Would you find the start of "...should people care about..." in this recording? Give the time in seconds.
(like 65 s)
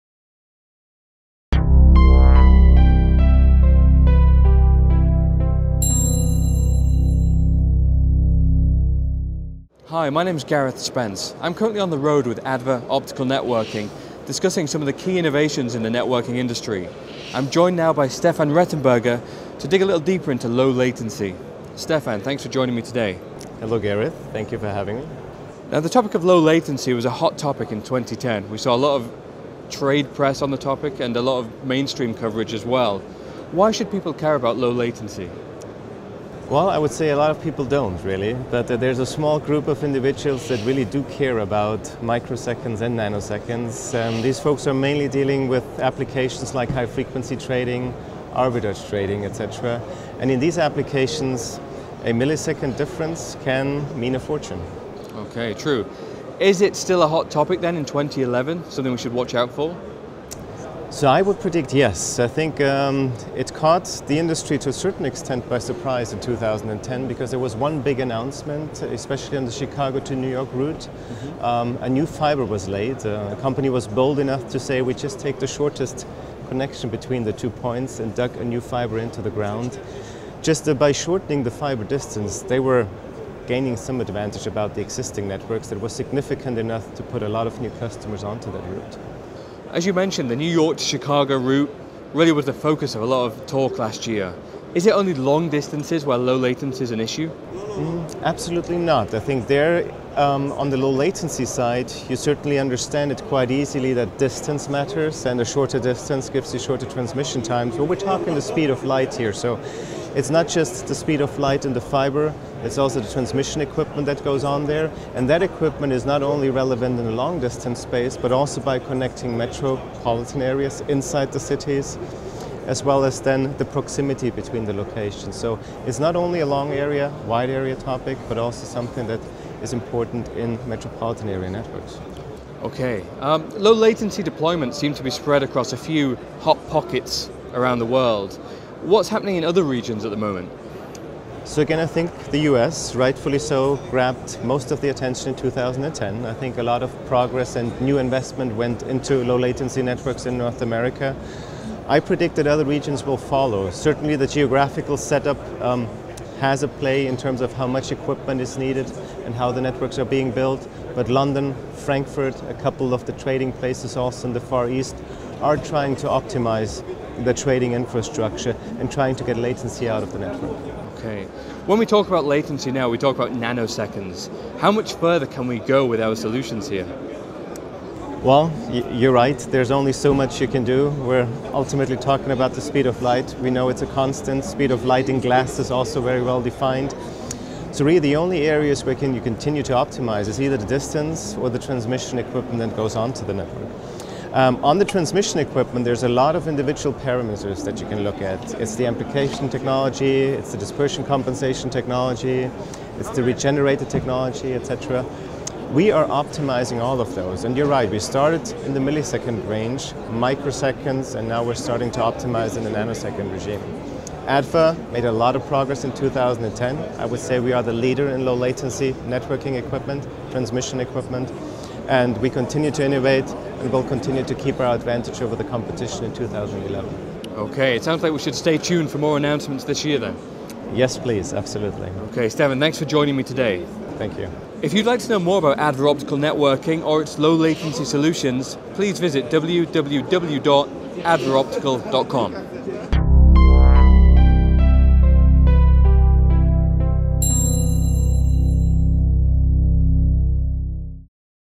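33 s.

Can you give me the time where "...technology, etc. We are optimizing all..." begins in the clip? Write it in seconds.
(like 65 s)
203 s.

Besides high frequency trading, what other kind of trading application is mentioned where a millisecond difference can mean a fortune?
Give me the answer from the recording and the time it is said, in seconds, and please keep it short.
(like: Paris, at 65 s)
Arbitrage trading, at 48 s.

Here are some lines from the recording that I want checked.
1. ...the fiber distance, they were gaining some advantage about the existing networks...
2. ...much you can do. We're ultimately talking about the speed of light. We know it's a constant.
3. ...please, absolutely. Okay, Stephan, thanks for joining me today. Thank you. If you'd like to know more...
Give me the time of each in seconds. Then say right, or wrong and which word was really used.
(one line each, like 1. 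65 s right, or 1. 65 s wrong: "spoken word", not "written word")
1. 81 s right
2. 180 s right
3. 230 s right.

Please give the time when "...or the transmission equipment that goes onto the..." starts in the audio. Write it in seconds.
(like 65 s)
191 s.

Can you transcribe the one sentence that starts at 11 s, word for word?
I'm currently on the road with ADVA Optical Networking, discussing some of the key innovations in the networking industry.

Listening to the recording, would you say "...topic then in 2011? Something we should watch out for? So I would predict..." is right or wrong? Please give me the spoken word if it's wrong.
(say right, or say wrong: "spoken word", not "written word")
right.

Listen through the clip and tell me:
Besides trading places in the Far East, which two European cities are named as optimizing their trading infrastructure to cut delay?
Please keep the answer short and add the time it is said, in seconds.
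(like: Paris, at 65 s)
London, Frankfurt, at 161 s.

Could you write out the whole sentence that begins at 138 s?
What's happening in other regions at the moment?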